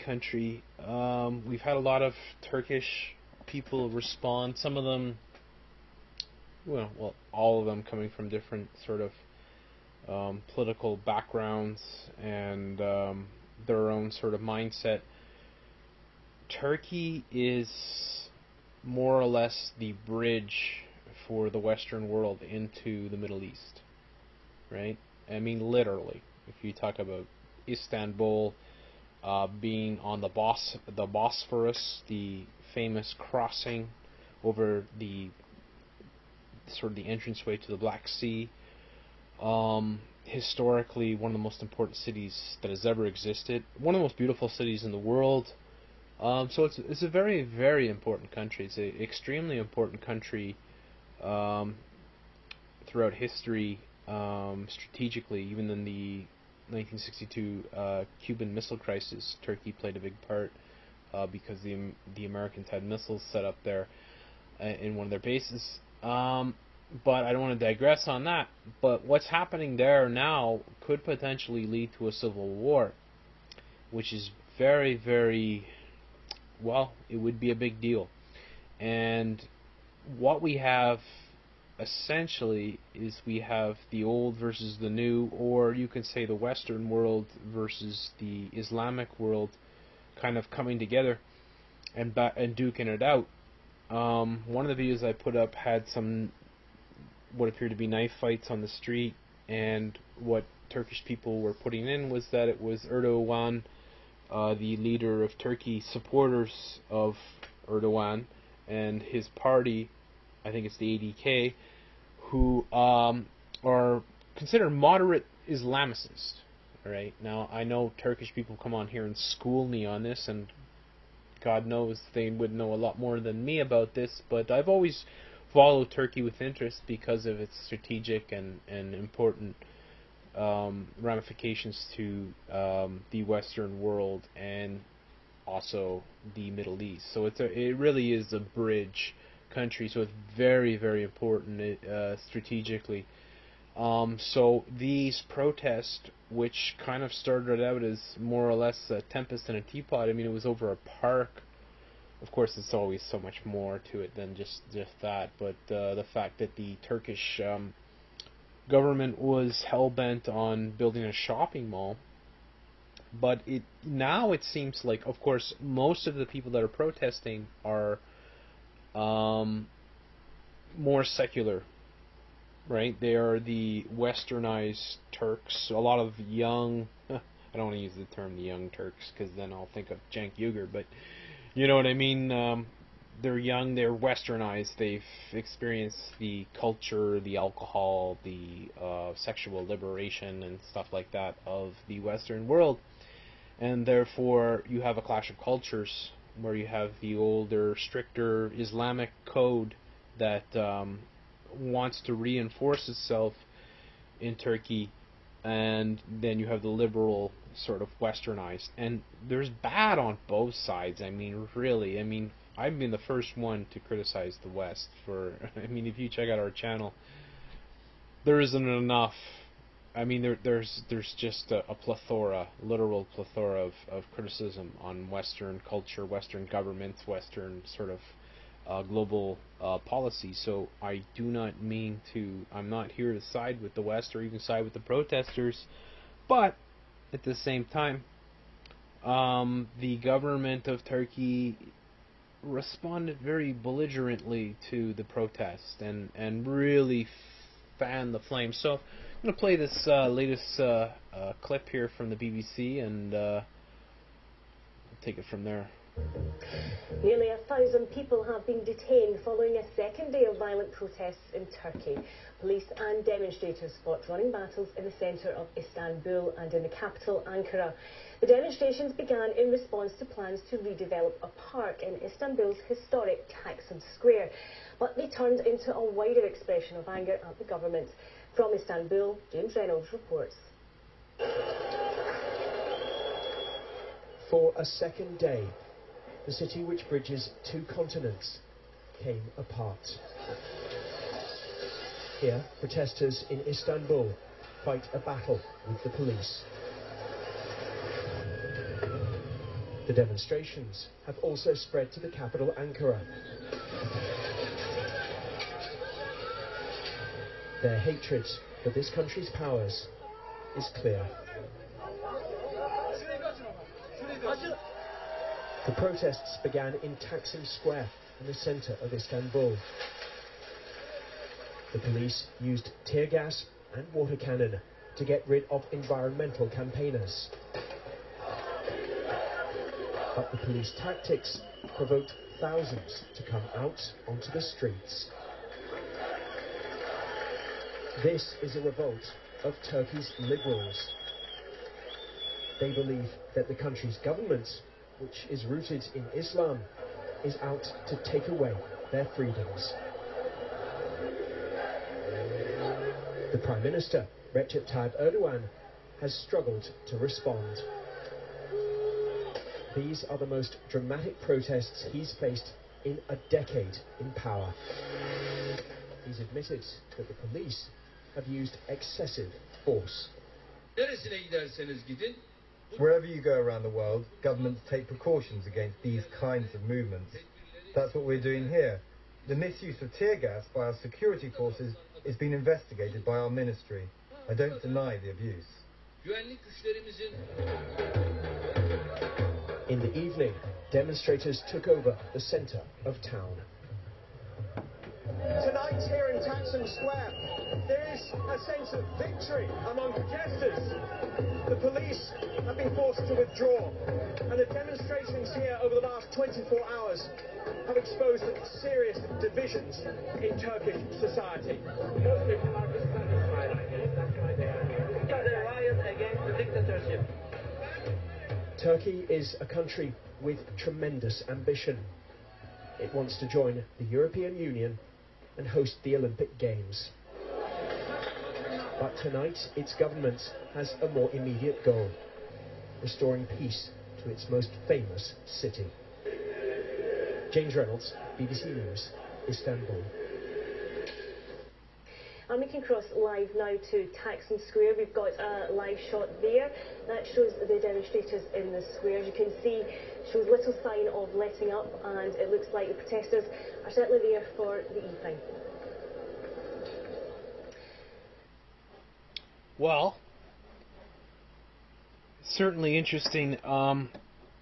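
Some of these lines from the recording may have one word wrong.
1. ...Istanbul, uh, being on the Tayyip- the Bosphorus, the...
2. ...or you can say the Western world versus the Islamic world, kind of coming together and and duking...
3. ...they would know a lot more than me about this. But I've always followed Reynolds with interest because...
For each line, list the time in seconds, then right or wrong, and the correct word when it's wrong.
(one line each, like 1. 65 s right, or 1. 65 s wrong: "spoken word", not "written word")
1. 27 s wrong: "Bos", not "Tayyip"
2. 85 s right
3. 122 s wrong: "Turkey", not "Reynolds".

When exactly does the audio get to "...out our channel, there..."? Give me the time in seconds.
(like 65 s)
216 s.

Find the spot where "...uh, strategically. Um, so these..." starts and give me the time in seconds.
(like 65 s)
141 s.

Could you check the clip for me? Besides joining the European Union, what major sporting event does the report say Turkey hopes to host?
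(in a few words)
The Olympic Games.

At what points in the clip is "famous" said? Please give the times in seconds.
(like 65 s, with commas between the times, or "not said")
32 s, 434 s.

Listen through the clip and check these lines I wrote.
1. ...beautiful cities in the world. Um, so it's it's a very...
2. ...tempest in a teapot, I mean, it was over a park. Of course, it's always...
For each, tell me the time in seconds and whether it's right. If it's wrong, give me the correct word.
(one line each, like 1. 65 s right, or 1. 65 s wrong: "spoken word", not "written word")
1. 44 s right
2. 149 s right.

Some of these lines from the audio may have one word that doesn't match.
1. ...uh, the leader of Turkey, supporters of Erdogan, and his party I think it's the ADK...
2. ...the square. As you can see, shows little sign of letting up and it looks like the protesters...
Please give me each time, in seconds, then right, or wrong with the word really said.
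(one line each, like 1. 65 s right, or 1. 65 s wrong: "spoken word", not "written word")
1. 104 s right
2. 448 s right.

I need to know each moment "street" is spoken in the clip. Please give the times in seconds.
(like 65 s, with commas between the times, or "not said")
98 s, 334 s.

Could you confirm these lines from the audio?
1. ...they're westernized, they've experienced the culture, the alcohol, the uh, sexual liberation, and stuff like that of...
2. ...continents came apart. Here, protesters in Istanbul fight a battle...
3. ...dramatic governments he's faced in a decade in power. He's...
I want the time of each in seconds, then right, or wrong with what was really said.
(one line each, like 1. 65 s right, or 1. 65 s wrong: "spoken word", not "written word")
1. 183 s right
2. 287 s right
3. 360 s wrong: "protests", not "governments".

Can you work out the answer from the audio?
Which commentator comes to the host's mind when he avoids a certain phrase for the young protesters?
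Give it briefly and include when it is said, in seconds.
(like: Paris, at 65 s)
Cenk Uygur, at 180 s.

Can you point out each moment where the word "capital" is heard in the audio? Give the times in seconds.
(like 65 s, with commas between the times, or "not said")
266 s, 302 s.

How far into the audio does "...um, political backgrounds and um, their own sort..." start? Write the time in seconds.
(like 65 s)
10 s.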